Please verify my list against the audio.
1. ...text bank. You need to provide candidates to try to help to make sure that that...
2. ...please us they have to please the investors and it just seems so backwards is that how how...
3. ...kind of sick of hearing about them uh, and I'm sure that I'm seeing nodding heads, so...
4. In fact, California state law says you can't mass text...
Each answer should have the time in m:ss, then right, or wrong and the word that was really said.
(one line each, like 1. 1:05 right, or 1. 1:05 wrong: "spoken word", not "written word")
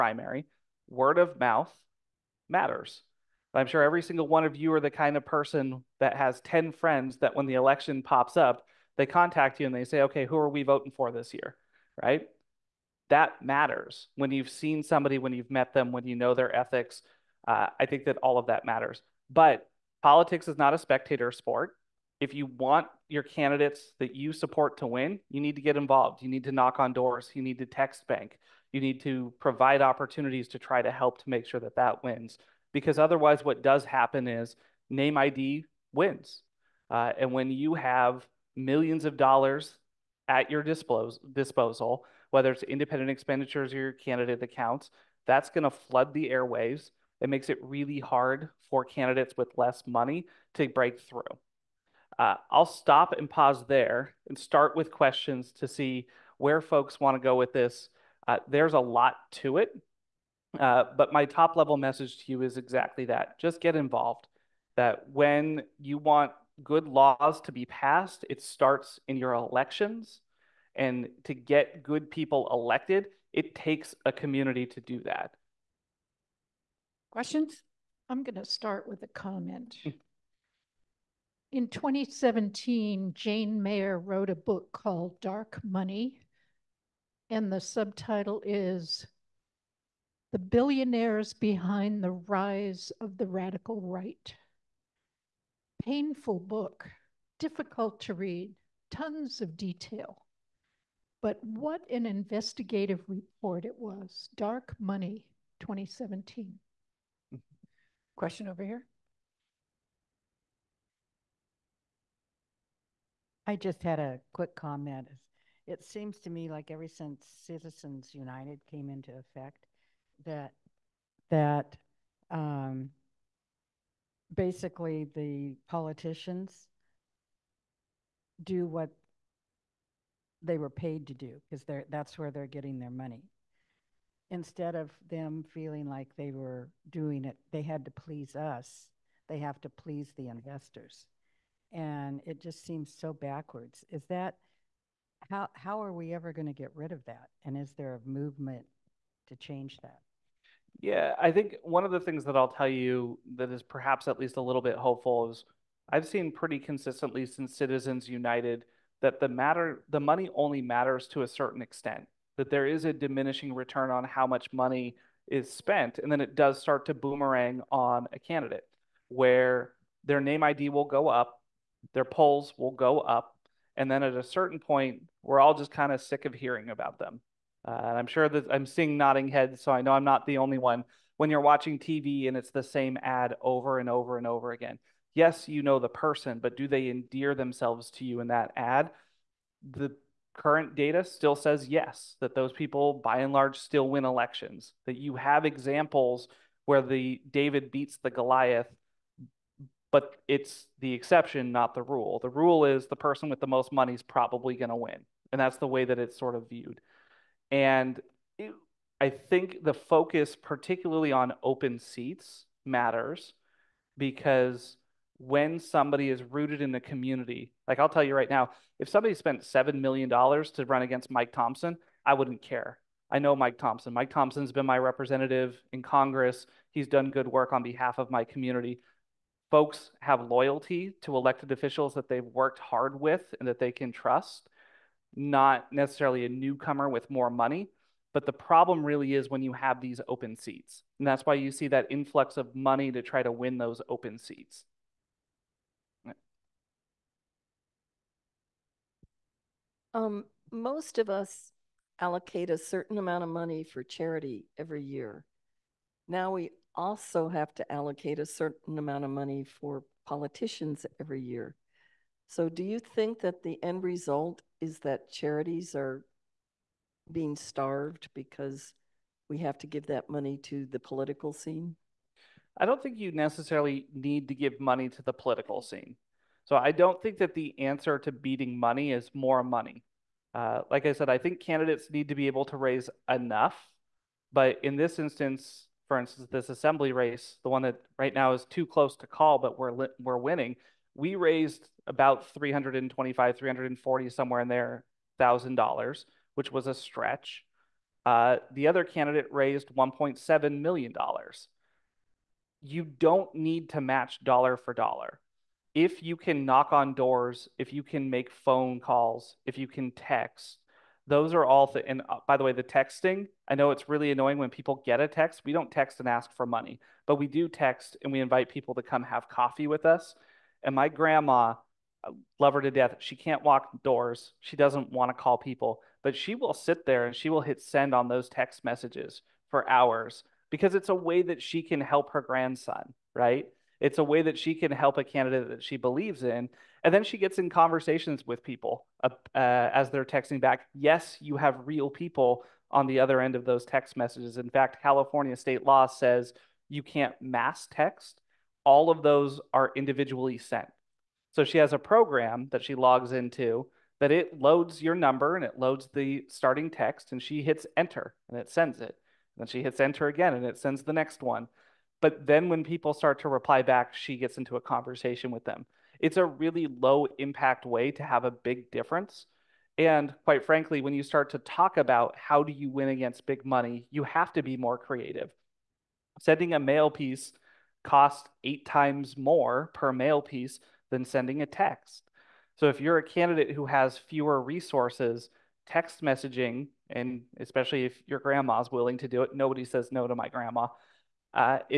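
1. 0:27 wrong: "opportunities", not "candidates"
2. 2:17 right
3. 2:55 right
4. 5:44 right.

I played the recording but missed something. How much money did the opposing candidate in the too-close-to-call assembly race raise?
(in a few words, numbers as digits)
$1.7 million.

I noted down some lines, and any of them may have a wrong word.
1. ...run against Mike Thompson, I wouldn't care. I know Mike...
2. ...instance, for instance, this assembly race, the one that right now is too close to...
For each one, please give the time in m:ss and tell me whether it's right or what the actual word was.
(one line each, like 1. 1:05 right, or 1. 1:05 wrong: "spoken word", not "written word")
1. 3:40 right
2. 4:44 right.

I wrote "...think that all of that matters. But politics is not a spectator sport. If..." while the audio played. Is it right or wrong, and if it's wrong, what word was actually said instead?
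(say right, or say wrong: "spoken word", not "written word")
right.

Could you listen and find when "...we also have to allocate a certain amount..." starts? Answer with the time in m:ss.
4:16.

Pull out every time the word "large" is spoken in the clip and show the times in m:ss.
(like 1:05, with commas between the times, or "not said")
3:13.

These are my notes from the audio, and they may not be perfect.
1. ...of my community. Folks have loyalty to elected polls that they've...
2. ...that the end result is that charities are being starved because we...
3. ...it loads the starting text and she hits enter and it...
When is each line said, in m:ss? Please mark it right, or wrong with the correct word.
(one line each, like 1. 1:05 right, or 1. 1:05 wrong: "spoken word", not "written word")
1. 3:47 wrong: "officials", not "polls"
2. 4:23 right
3. 5:55 right.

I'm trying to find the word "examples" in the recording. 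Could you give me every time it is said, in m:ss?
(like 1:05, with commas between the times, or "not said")
3:15.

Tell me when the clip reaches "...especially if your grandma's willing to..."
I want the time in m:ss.
6:27.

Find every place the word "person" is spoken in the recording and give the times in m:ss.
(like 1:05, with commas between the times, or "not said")
0:05, 3:05, 3:22.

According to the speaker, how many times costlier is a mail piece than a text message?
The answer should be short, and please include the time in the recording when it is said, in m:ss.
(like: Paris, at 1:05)
8 times, at 6:18.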